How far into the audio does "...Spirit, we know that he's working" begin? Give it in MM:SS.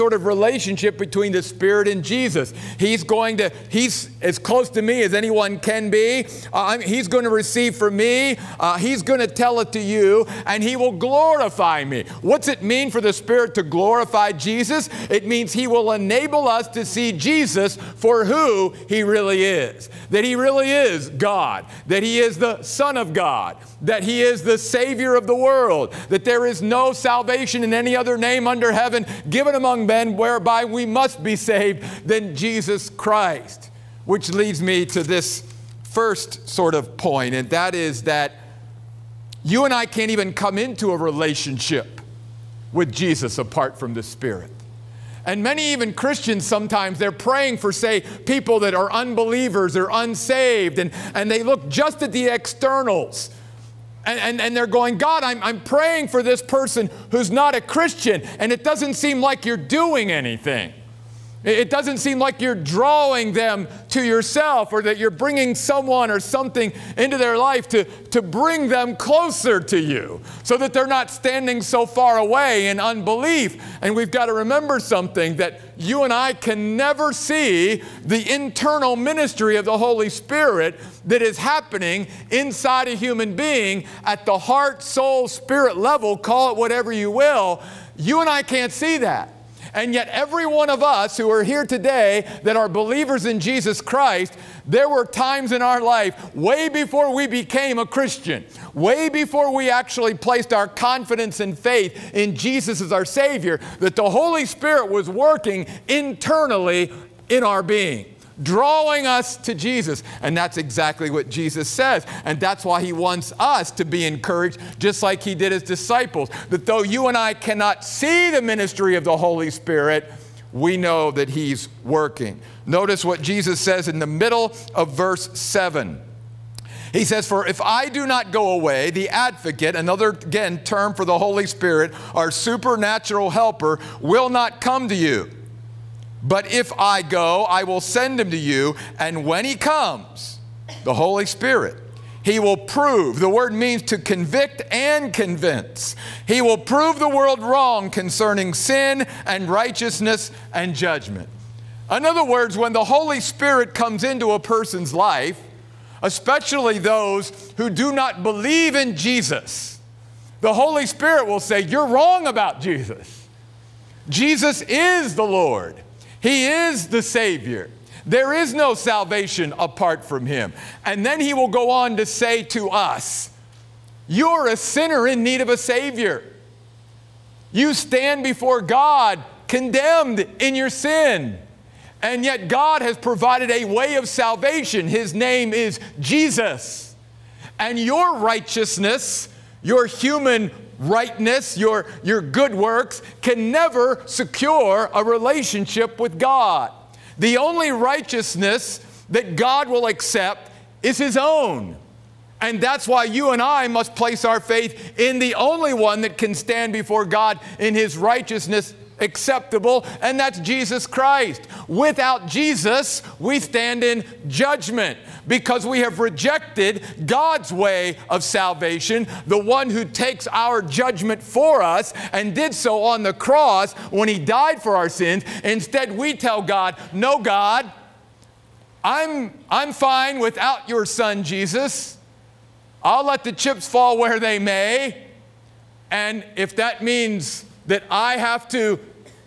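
01:59.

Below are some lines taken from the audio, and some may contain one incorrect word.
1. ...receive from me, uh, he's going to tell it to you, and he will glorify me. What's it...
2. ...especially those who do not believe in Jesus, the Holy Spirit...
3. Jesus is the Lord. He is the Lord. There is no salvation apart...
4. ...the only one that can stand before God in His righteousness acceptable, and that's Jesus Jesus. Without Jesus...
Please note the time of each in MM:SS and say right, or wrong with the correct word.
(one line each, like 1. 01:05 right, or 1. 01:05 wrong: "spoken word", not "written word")
1. 00:07 right
2. 02:36 right
3. 02:44 wrong: "Savior", not "Lord"
4. 03:25 wrong: "Christ", not "Jesus".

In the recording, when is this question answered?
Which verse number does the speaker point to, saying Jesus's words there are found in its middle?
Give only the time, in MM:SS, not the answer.
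02:04.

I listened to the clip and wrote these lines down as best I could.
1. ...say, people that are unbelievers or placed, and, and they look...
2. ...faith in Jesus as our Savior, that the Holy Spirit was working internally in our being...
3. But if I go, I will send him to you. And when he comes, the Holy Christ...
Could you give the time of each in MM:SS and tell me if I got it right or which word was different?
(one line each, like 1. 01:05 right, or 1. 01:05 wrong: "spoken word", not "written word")
1. 00:47 wrong: "unsaved", not "placed"
2. 01:41 right
3. 02:16 wrong: "Spirit", not "Christ".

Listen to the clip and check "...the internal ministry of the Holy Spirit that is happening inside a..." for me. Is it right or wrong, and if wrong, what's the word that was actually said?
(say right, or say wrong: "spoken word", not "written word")
right.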